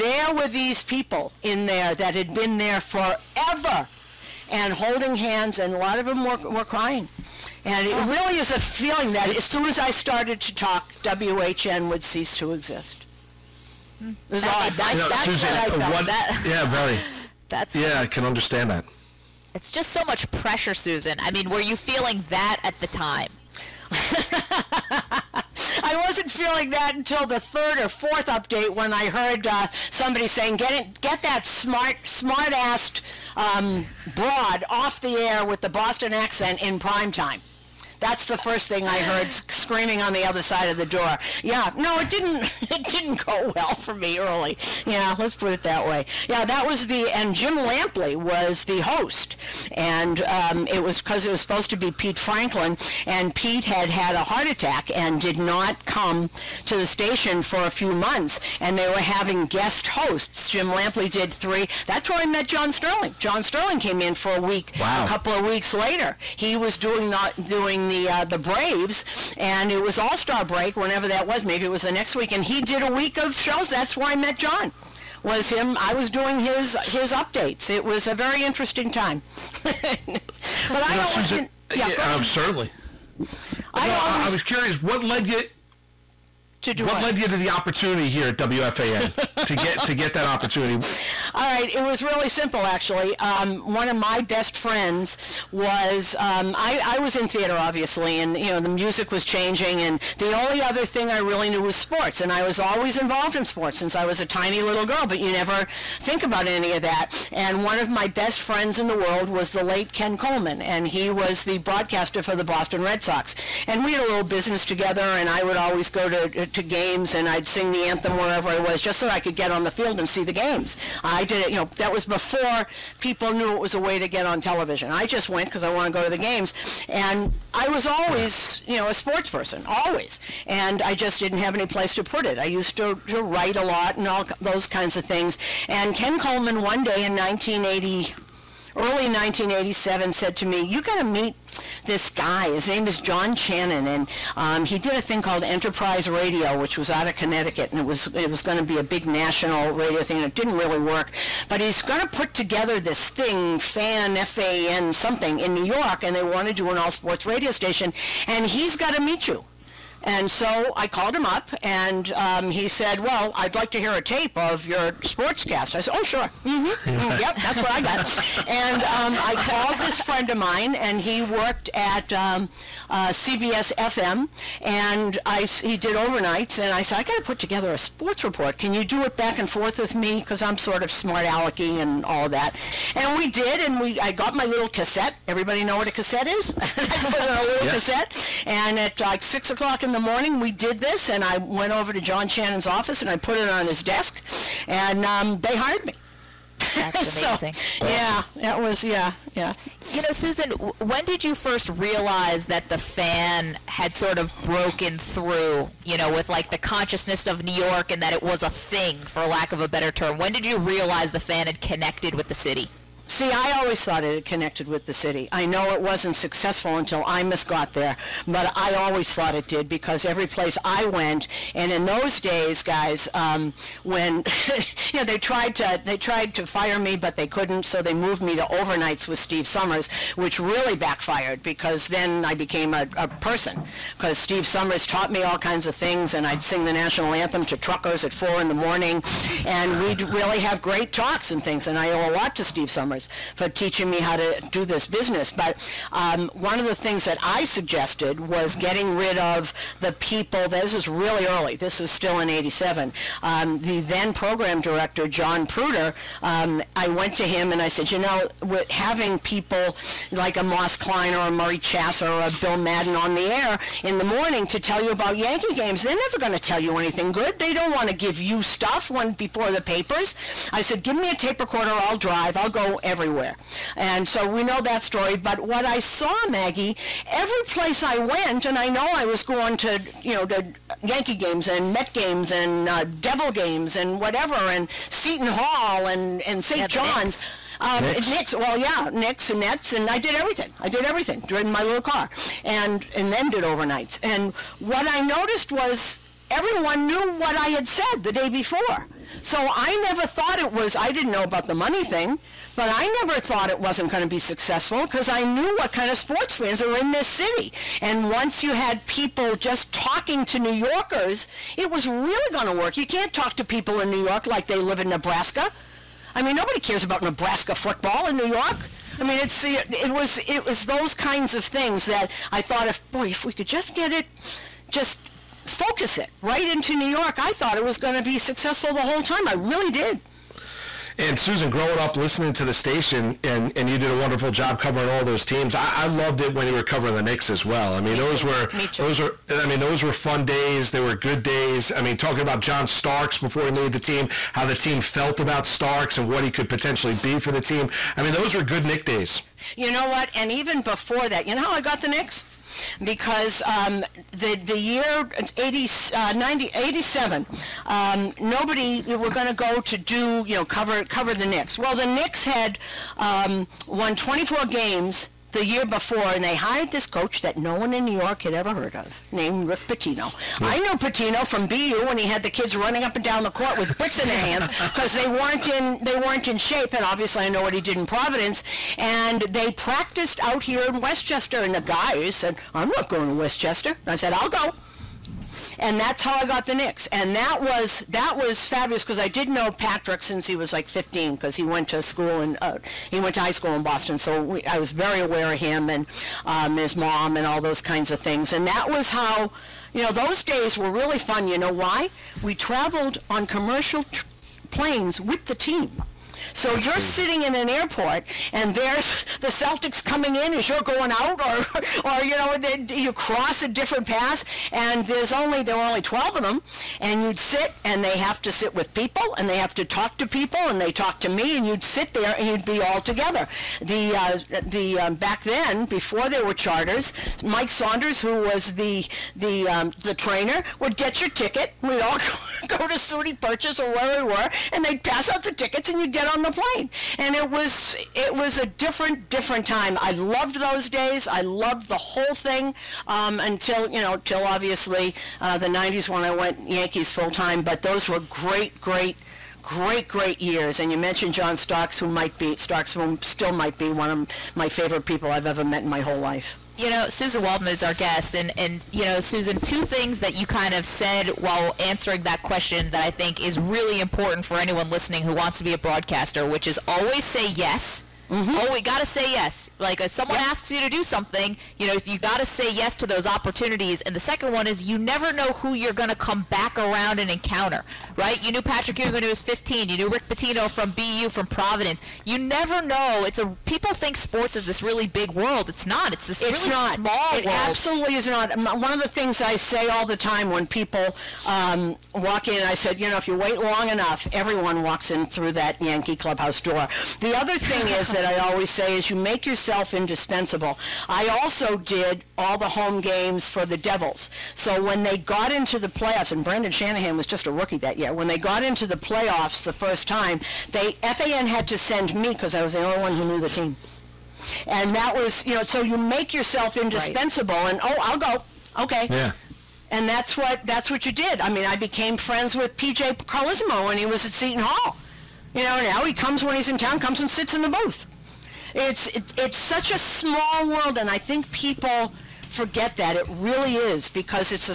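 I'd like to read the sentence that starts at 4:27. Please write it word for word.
They don't want to give you stuff when before the papers.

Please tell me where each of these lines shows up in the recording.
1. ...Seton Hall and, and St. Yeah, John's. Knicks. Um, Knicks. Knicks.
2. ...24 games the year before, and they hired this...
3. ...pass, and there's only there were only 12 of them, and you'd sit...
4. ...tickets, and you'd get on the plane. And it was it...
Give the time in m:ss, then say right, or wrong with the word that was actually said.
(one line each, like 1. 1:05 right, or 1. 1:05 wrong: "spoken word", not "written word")
1. 4:44 right
2. 6:03 right
3. 6:53 right
4. 7:15 right.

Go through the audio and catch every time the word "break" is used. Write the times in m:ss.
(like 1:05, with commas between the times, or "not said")
1:10.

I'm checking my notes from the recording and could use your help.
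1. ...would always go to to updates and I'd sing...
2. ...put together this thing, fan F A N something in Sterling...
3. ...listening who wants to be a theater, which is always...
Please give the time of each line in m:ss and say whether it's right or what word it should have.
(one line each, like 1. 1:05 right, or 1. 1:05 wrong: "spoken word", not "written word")
1. 1:55 wrong: "games", not "updates"
2. 2:32 wrong: "New", not "Sterling"
3. 7:44 wrong: "broadcaster", not "theater".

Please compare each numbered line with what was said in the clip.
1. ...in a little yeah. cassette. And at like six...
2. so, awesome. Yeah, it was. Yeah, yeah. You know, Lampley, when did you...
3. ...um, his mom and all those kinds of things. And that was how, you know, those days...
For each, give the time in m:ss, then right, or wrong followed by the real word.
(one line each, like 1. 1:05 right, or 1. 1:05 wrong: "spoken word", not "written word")
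1. 3:07 right
2. 3:17 wrong: "Susan", not "Lampley"
3. 6:36 right.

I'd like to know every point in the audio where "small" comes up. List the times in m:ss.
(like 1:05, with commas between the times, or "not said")
8:06, 8:49.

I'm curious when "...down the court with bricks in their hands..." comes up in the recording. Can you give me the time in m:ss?
6:13.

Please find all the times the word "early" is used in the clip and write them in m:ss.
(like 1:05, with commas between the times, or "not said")
0:44, 2:18, 4:11.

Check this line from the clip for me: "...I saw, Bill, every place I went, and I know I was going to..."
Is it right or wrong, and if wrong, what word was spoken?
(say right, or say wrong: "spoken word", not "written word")
wrong: "Maggie", not "Bill".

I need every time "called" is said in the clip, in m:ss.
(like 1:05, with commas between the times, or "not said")
2:25, 2:40, 2:49.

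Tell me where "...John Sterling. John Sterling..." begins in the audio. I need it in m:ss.
1:02.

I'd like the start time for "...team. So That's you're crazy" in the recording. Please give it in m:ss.
6:45.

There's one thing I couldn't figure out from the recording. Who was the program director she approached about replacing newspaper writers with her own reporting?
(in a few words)
John Pruder.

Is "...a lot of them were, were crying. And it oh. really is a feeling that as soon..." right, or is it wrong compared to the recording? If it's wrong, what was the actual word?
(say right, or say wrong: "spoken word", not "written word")
right.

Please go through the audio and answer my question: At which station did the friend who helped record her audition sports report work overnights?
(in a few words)
CBS FM.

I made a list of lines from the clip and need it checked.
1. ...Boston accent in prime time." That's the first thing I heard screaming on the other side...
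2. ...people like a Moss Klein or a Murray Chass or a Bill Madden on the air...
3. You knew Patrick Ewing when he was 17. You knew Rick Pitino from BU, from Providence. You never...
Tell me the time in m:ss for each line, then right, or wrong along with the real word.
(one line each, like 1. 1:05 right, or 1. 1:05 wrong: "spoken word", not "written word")
1. 0:35 right
2. 4:19 right
3. 7:58 wrong: "15", not "17".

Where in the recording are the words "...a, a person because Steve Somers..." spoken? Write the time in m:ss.
3:52.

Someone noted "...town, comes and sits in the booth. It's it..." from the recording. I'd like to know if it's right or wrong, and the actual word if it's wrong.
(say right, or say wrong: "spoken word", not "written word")
right.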